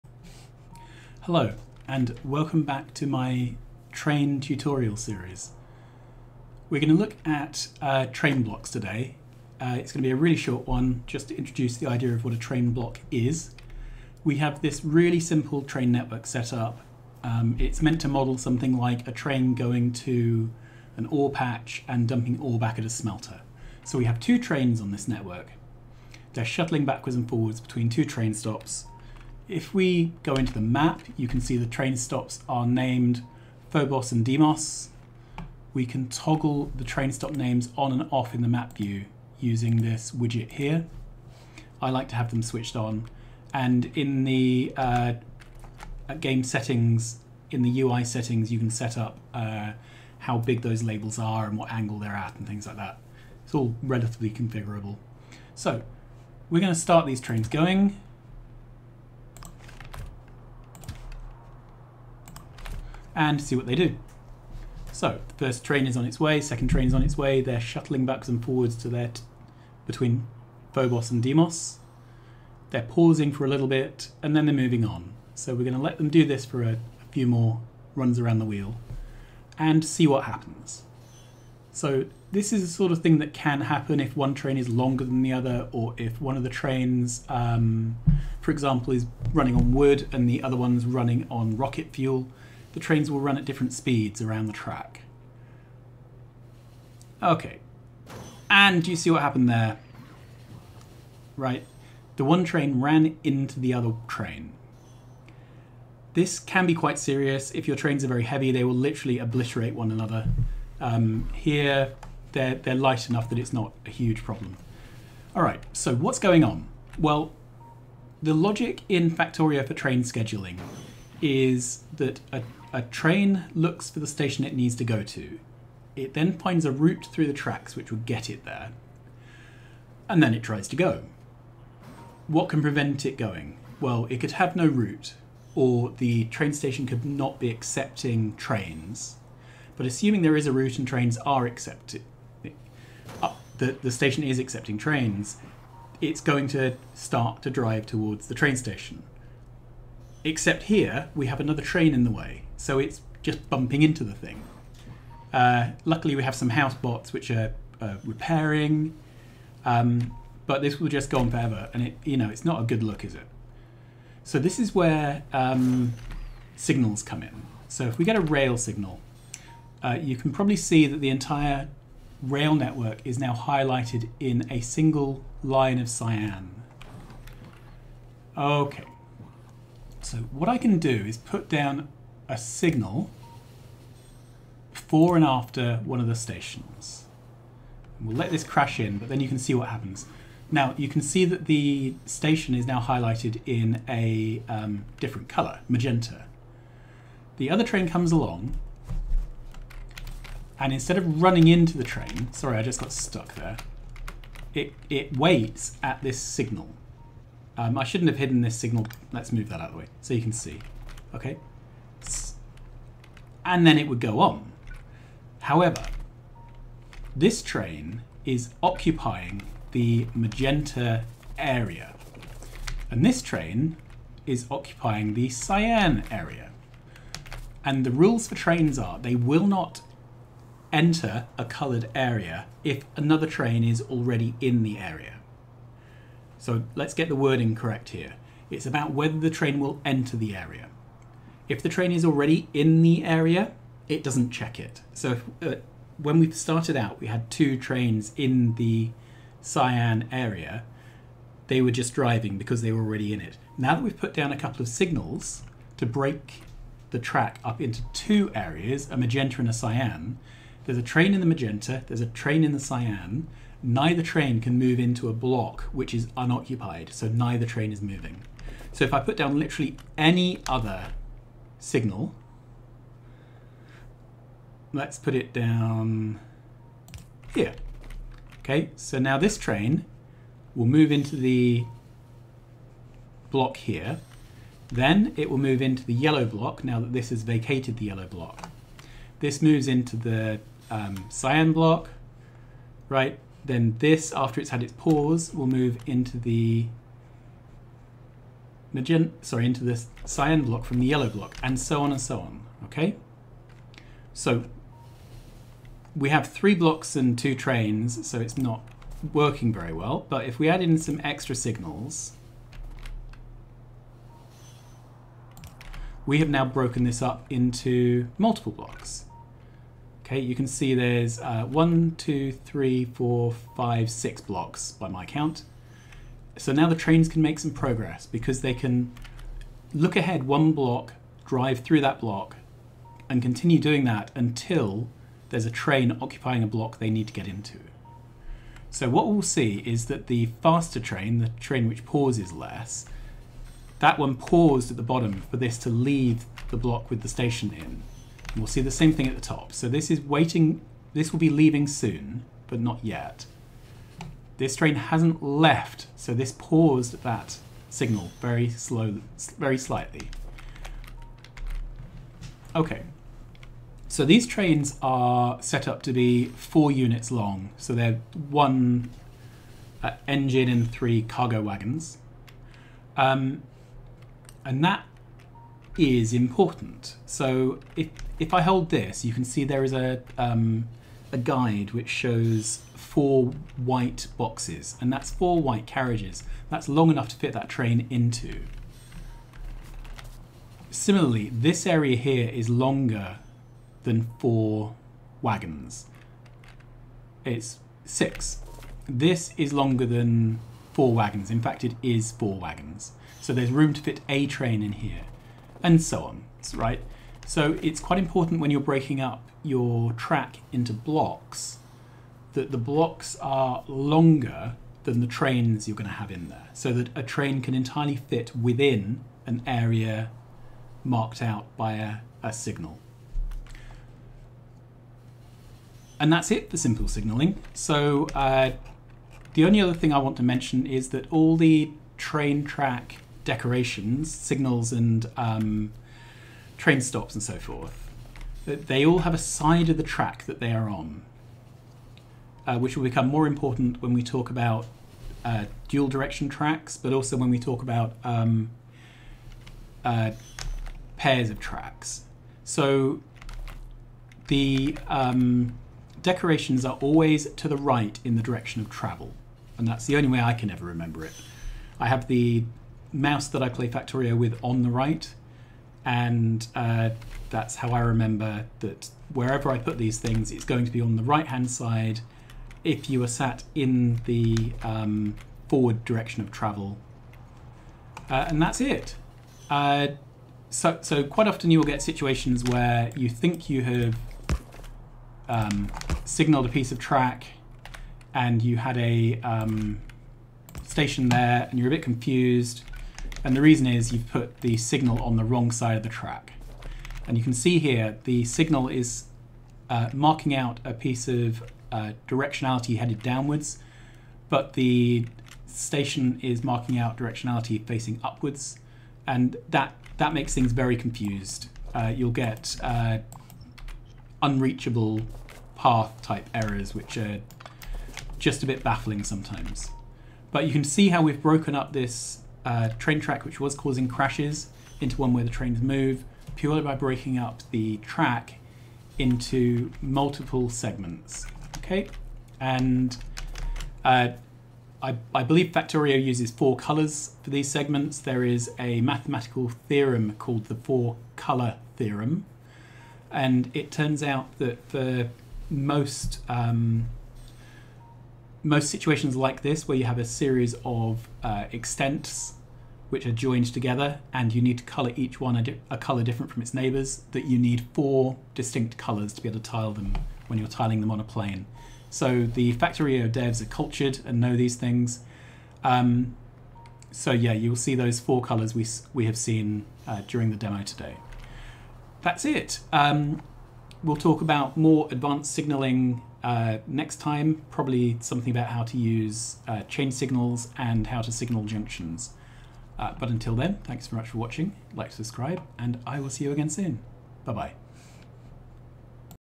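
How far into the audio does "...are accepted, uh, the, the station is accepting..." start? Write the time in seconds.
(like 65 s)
141 s.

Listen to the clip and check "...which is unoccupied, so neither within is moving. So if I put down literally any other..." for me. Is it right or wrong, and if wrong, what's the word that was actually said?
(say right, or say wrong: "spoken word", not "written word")
wrong: "train", not "within".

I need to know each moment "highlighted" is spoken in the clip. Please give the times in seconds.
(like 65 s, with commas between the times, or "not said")
173 s, 192 s.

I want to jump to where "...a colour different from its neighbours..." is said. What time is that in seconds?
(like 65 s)
555 s.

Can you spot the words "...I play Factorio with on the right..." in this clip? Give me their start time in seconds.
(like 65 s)
463 s.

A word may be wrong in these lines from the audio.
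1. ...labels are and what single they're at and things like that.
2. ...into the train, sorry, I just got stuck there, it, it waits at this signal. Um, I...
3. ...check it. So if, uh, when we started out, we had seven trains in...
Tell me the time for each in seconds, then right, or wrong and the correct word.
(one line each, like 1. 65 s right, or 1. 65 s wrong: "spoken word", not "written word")
1. 50 s wrong: "angle", not "single"
2. 201 s right
3. 244 s wrong: "two", not "seven".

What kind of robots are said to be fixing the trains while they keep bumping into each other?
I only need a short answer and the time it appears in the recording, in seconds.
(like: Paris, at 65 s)
House bots, at 156 s.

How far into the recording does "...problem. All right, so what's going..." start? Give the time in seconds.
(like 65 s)
114 s.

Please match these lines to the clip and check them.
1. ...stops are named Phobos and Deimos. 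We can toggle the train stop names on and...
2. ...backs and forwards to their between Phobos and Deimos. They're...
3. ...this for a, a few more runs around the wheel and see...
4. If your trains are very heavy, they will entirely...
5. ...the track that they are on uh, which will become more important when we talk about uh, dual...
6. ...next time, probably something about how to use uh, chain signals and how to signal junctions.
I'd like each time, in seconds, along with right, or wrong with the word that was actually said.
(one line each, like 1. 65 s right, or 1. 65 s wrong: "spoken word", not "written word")
1. 31 s right
2. 68 s right
3. 76 s right
4. 107 s wrong: "literally", not "entirely"
5. 439 s right
6. 576 s right.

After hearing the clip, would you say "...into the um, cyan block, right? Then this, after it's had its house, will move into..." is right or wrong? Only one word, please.
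wrong.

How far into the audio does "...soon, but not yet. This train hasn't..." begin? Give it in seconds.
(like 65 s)
351 s.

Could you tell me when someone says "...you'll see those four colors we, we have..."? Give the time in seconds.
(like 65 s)
567 s.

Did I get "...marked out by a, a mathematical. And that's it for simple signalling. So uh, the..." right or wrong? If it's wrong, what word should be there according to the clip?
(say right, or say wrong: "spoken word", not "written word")
wrong: "signal", not "mathematical".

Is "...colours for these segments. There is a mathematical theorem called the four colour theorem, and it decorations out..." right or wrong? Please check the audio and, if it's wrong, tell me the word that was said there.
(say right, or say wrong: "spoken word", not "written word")
wrong: "turns", not "decorations".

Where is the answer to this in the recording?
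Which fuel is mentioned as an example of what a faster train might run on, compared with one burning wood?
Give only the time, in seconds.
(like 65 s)
91 s.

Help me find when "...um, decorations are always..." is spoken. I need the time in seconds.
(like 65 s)
454 s.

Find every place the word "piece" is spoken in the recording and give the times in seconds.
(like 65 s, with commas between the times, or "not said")
486 s, 500 s.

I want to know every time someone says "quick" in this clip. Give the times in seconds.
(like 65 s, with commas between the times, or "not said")
not said.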